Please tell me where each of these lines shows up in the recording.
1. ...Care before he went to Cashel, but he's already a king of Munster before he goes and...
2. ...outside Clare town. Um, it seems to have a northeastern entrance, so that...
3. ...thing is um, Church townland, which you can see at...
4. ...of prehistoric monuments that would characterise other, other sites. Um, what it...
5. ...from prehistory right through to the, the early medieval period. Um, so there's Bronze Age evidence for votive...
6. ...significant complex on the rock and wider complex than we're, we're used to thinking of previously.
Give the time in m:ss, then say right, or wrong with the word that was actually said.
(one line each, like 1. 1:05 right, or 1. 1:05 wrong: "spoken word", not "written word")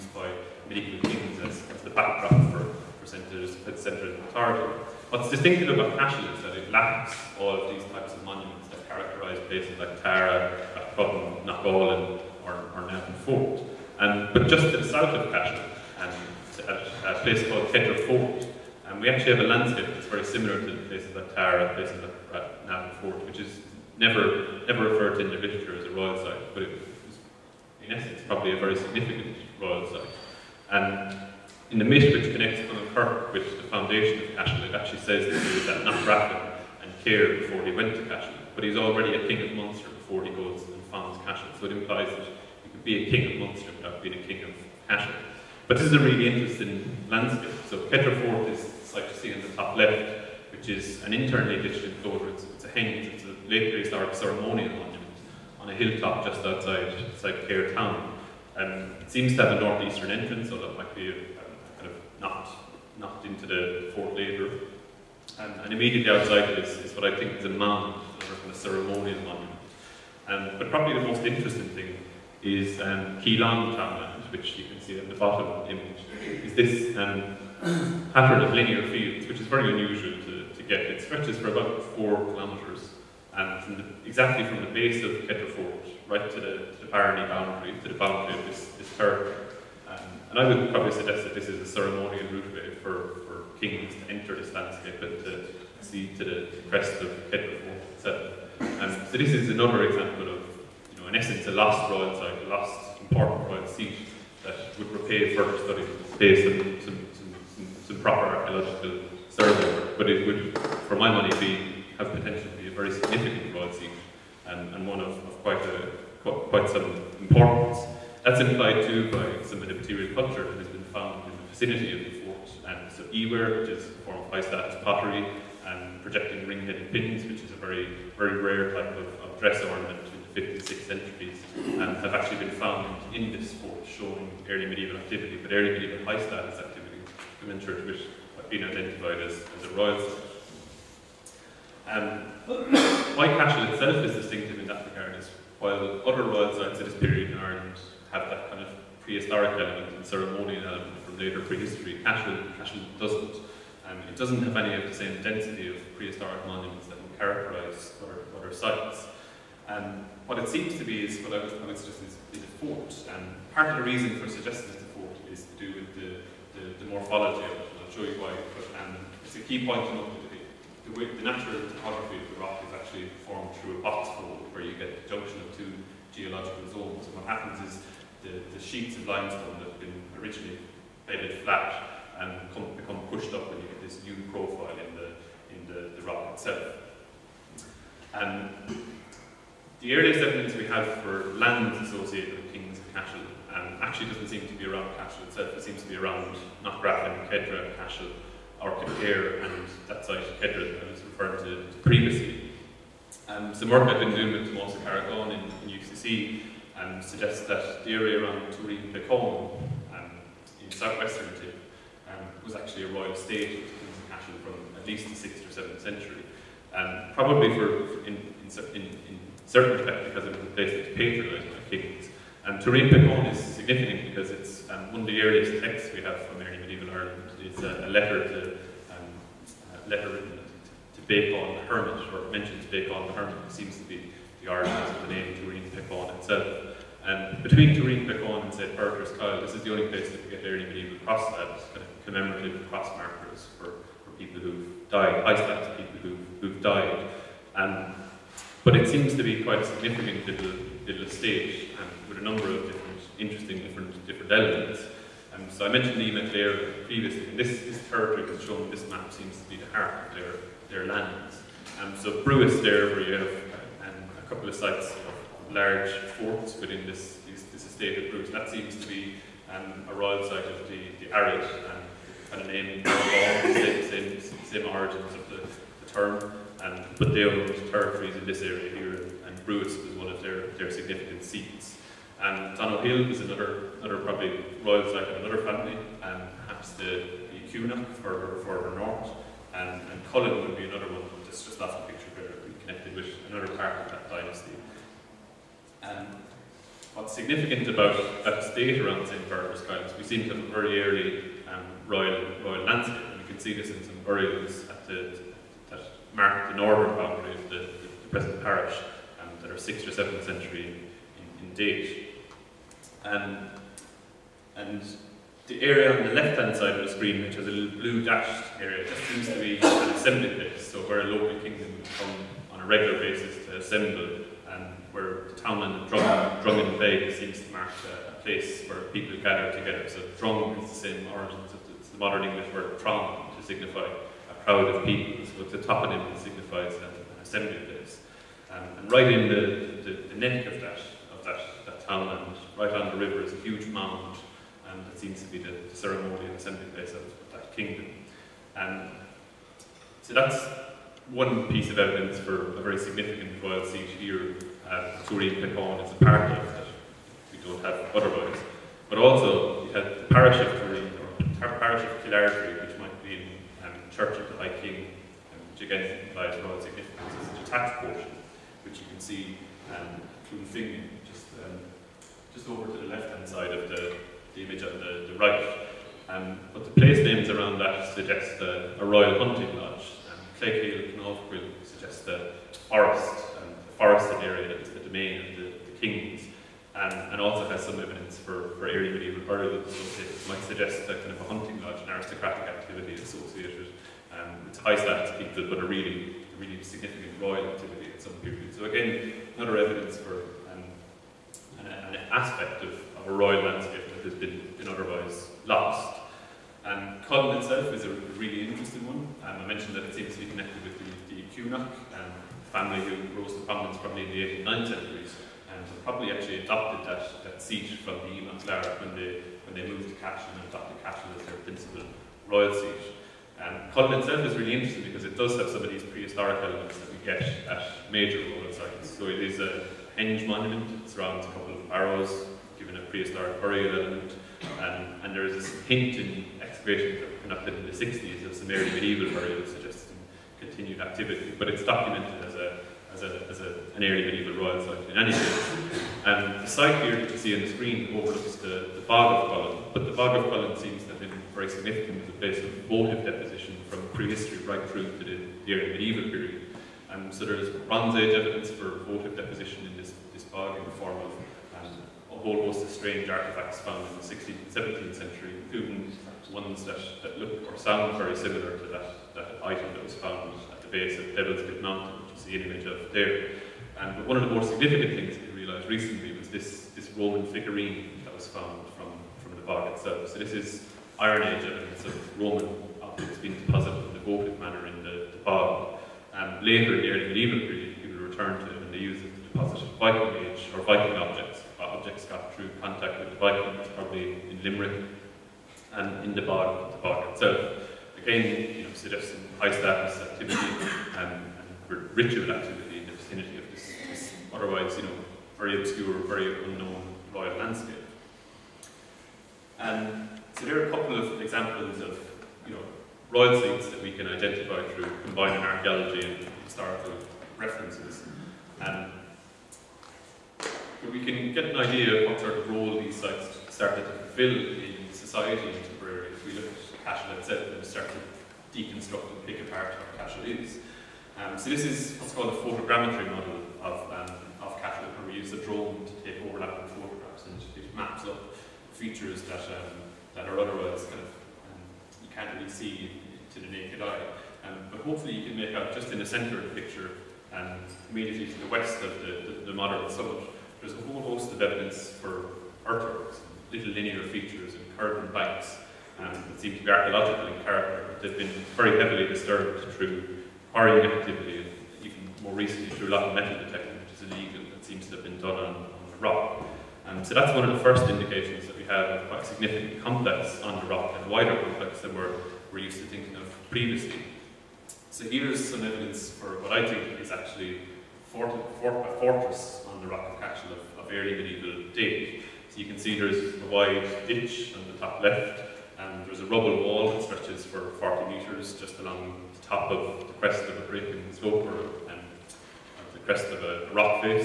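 1. 0:37 right
2. 0:57 right
3. 1:11 wrong: "Keelong", not "Church"
4. 2:35 right
5. 7:33 right
6. 9:29 right.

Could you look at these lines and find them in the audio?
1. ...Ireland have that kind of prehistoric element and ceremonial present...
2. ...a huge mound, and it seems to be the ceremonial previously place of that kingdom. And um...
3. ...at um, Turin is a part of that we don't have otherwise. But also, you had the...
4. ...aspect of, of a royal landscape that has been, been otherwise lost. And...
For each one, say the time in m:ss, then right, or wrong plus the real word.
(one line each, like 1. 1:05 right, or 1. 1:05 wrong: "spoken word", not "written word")
1. 2:27 wrong: "element", not "present"
2. 5:43 wrong: "assembly", not "previously"
3. 5:54 right
4. 6:42 right.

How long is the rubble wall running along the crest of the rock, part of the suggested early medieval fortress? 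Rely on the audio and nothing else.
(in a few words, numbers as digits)
40 metres.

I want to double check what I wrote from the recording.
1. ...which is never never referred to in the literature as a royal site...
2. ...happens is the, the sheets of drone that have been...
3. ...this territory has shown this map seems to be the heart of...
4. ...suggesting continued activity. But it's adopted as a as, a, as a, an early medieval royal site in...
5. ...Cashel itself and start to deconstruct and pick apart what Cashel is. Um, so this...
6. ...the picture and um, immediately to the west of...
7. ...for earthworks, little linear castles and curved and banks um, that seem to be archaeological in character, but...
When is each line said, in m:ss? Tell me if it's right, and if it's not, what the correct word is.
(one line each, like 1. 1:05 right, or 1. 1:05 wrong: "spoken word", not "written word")
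1. 0:23 right
2. 2:57 wrong: "limestone", not "drone"
3. 4:17 right
4. 7:19 wrong: "documented", not "adopted"
5. 8:46 right
6. 9:06 right
7. 9:11 wrong: "features", not "castles".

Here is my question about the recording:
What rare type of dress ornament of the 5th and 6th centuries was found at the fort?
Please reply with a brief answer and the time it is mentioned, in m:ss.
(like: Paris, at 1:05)
Projecting ring-headed pins, at 2:06.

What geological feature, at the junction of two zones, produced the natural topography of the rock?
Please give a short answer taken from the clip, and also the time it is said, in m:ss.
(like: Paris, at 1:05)
A box fold, at 2:53.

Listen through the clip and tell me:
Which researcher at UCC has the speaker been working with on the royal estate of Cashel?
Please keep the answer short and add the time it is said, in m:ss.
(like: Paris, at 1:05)
Tomás Carragáin, at 3:24.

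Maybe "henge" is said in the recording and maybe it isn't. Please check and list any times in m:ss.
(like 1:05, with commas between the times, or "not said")
0:52, 7:09.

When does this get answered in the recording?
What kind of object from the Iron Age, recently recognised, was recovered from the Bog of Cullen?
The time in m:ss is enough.
7:56.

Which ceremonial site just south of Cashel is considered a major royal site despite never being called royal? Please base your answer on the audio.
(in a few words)
Petra Fort.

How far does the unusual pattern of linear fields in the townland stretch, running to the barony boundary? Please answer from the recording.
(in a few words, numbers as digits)
4 kilometres.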